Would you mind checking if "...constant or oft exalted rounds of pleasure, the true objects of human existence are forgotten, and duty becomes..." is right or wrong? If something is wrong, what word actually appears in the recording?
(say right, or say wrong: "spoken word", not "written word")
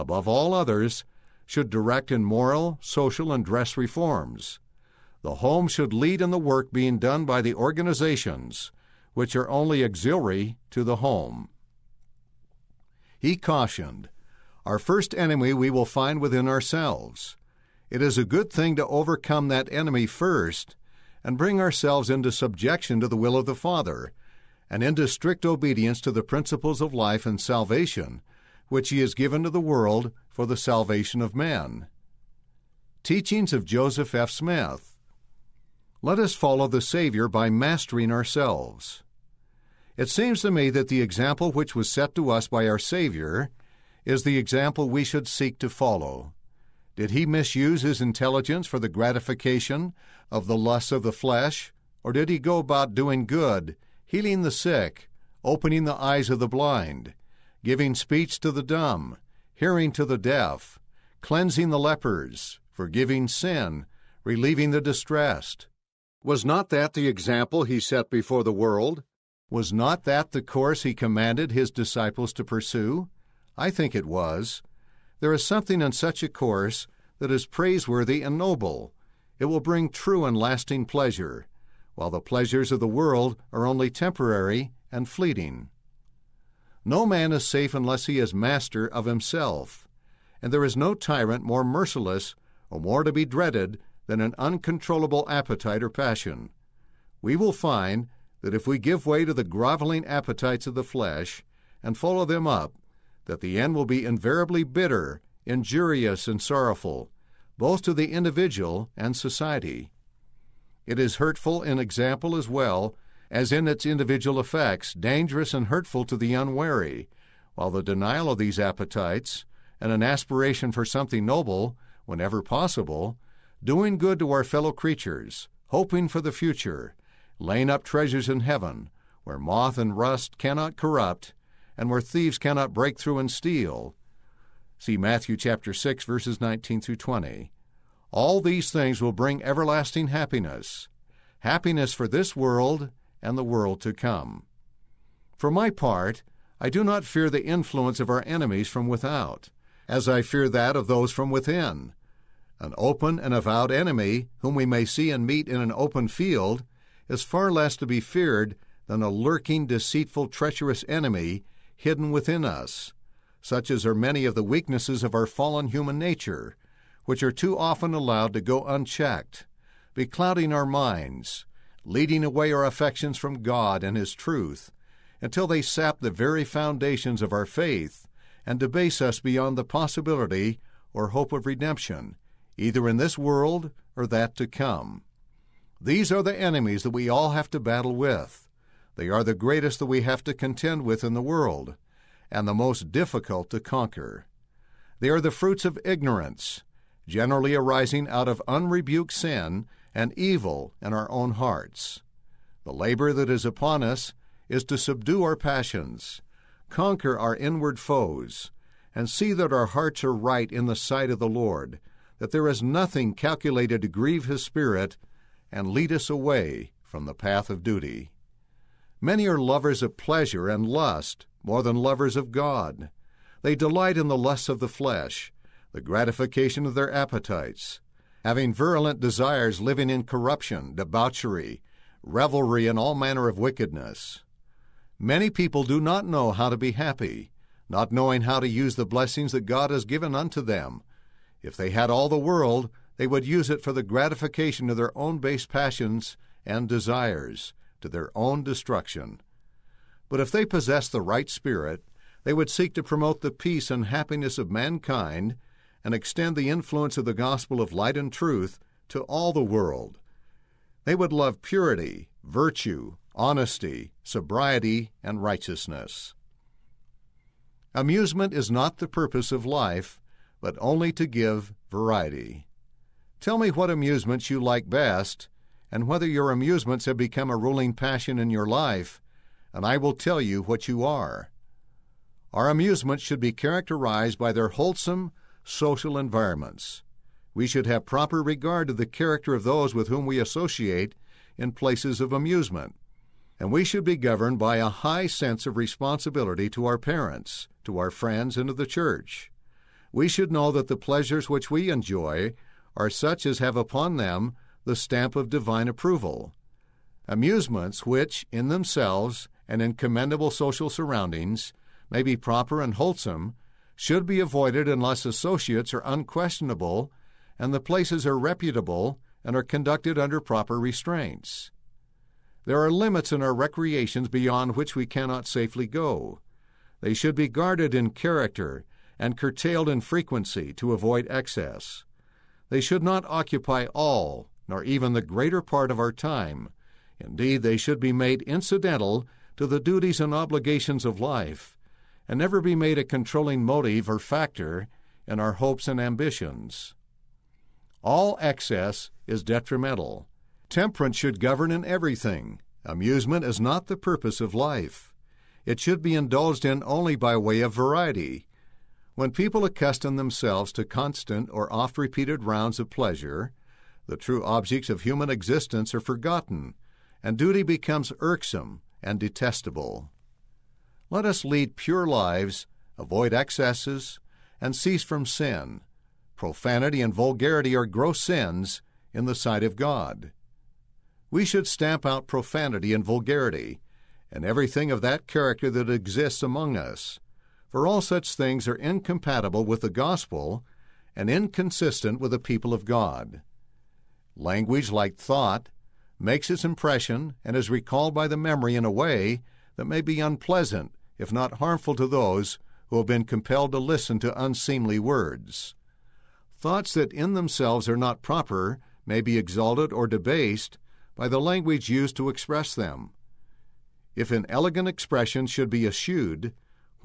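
wrong: "repeated", not "exalted".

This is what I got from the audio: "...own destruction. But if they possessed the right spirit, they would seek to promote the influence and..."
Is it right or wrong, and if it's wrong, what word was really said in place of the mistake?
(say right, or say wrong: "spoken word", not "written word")
wrong: "peace", not "influence".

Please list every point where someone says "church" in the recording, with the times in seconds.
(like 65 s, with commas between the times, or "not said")
298 s.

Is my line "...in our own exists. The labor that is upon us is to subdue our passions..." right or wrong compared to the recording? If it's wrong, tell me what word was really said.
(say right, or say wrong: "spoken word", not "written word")
wrong: "hearts", not "exists".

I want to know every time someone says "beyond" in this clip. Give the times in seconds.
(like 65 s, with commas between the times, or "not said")
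179 s, 324 s.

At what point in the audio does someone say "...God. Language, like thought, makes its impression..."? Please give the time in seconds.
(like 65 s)
392 s.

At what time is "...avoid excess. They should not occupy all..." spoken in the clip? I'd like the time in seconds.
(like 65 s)
330 s.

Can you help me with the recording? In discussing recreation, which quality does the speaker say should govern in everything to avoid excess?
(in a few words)
Temperance.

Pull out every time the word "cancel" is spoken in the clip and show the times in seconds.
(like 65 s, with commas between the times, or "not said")
not said.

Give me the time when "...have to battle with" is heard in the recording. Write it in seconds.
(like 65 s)
187 s.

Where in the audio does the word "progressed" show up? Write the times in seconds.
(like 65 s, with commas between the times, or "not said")
not said.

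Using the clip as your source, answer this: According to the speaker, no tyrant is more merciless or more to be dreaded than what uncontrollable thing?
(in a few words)
appetite or passion.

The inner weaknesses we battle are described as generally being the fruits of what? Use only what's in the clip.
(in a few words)
ignorance.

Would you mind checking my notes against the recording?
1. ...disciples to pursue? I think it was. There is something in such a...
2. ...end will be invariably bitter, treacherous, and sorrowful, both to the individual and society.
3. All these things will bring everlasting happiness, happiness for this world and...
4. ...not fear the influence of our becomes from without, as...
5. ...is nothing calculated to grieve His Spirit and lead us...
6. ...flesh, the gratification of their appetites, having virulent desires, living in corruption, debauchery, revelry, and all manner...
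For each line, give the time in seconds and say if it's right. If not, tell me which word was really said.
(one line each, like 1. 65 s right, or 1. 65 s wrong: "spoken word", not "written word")
1. 71 s right
2. 103 s wrong: "injurious", not "treacherous"
3. 138 s right
4. 146 s wrong: "enemies", not "becomes"
5. 212 s right
6. 224 s right.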